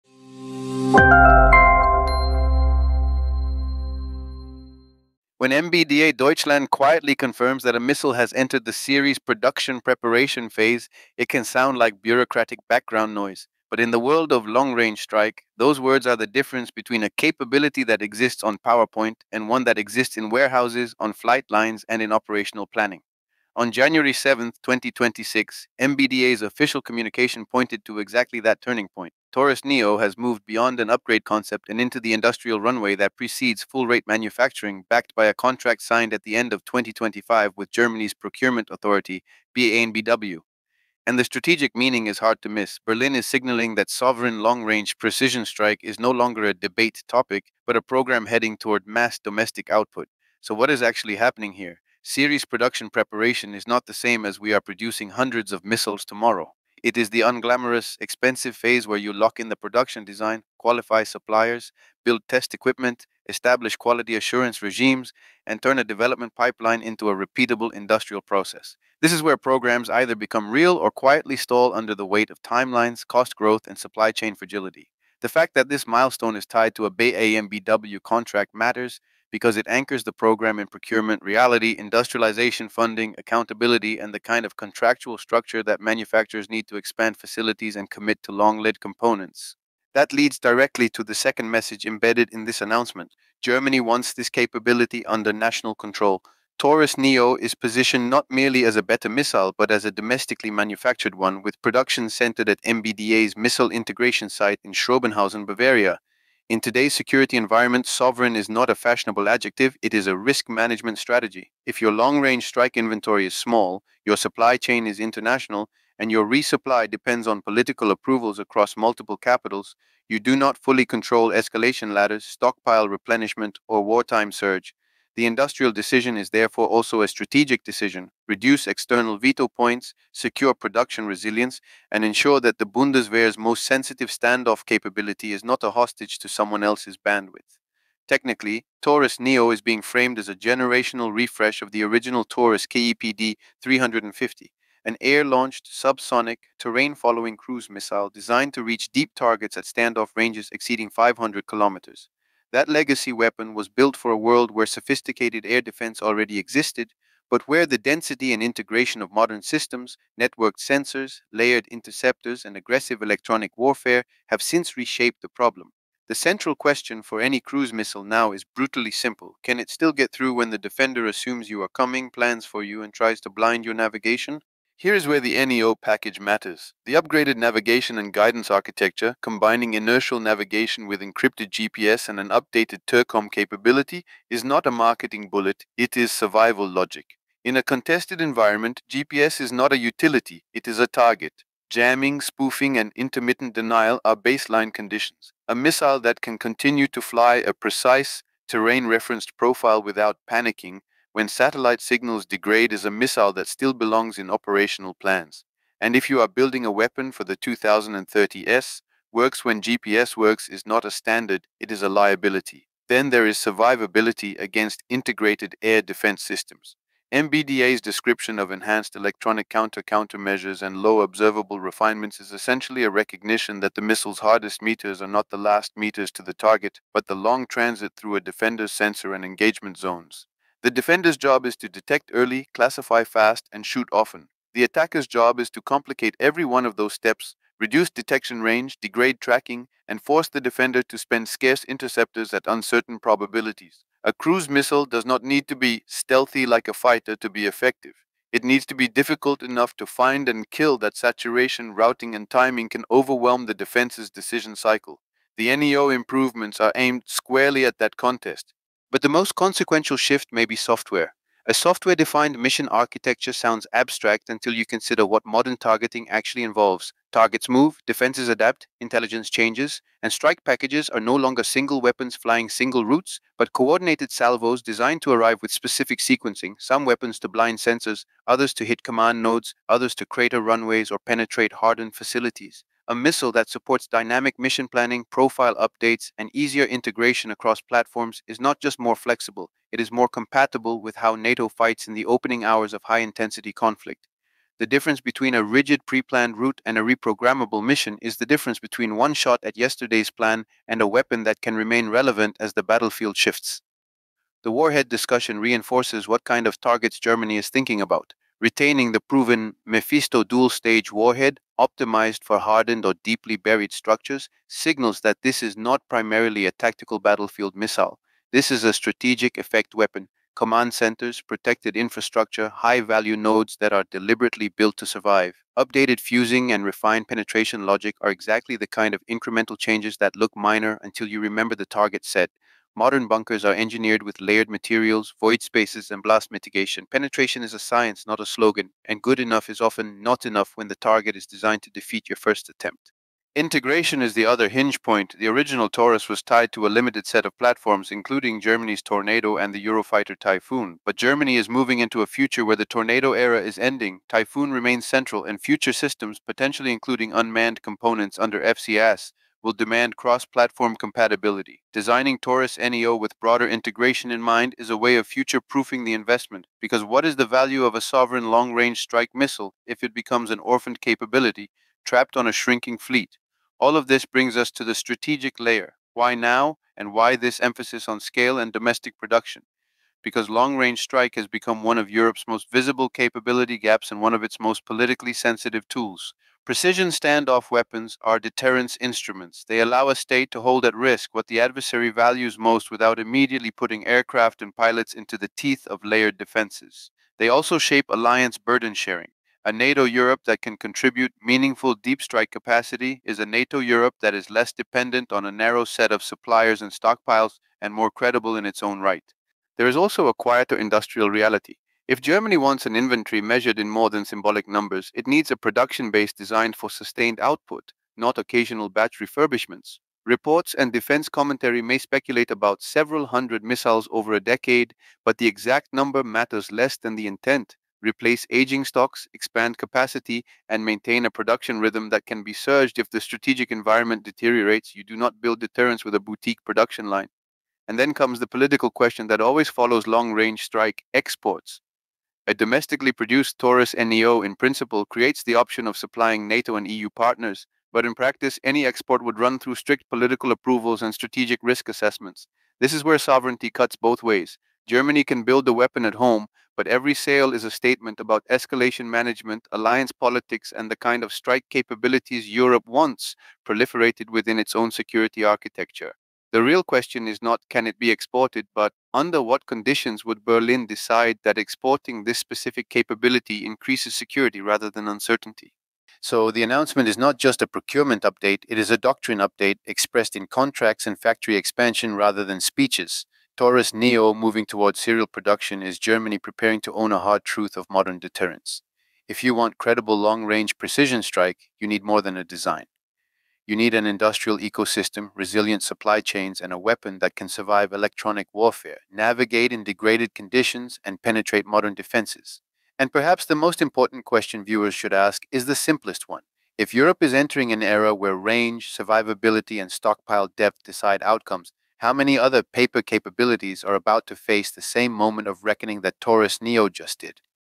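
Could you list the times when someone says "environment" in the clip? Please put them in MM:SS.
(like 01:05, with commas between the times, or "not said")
01:47, 03:08, 07:13.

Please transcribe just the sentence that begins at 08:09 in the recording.
If you want credible long range precision strike, you need more than a design.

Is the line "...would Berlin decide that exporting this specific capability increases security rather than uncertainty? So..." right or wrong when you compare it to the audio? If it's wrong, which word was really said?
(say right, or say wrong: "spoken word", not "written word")
right.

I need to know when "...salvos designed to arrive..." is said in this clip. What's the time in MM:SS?
04:34.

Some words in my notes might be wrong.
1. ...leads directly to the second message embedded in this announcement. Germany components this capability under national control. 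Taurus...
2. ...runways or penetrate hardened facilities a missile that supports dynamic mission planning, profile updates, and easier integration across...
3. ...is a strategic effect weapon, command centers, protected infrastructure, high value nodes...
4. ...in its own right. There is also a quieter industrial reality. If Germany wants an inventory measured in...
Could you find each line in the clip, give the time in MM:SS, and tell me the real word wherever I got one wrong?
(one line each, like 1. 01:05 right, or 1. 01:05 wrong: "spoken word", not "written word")
1. 01:30 wrong: "wants", not "components"
2. 04:40 right
3. 05:18 right
4. 06:48 right.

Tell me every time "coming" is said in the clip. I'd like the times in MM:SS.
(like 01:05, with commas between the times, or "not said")
02:51.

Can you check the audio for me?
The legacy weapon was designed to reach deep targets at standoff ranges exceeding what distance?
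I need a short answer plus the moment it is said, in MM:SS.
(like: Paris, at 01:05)
500 kilometers, at 02:30.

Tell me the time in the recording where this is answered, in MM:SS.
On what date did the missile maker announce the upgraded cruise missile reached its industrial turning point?
00:23.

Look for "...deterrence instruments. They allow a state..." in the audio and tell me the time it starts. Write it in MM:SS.
06:28.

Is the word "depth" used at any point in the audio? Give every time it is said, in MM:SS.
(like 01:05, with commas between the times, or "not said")
08:30.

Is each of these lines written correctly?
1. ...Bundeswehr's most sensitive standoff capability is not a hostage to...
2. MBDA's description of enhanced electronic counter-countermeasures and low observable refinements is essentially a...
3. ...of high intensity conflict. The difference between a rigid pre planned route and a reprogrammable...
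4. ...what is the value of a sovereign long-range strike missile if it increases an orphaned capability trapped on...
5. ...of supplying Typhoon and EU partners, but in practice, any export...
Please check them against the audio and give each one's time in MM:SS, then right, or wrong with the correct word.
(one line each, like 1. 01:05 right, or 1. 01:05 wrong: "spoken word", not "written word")
1. 02:12 right
2. 03:37 right
3. 04:52 right
4. 06:06 wrong: "becomes", not "increases"
5. 07:25 wrong: "NATO", not "Typhoon".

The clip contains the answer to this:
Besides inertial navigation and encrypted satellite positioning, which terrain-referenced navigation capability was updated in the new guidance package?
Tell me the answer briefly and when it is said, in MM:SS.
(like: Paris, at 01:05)
TERCOM, at 03:02.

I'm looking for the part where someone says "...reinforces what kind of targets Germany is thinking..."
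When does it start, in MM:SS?
05:05.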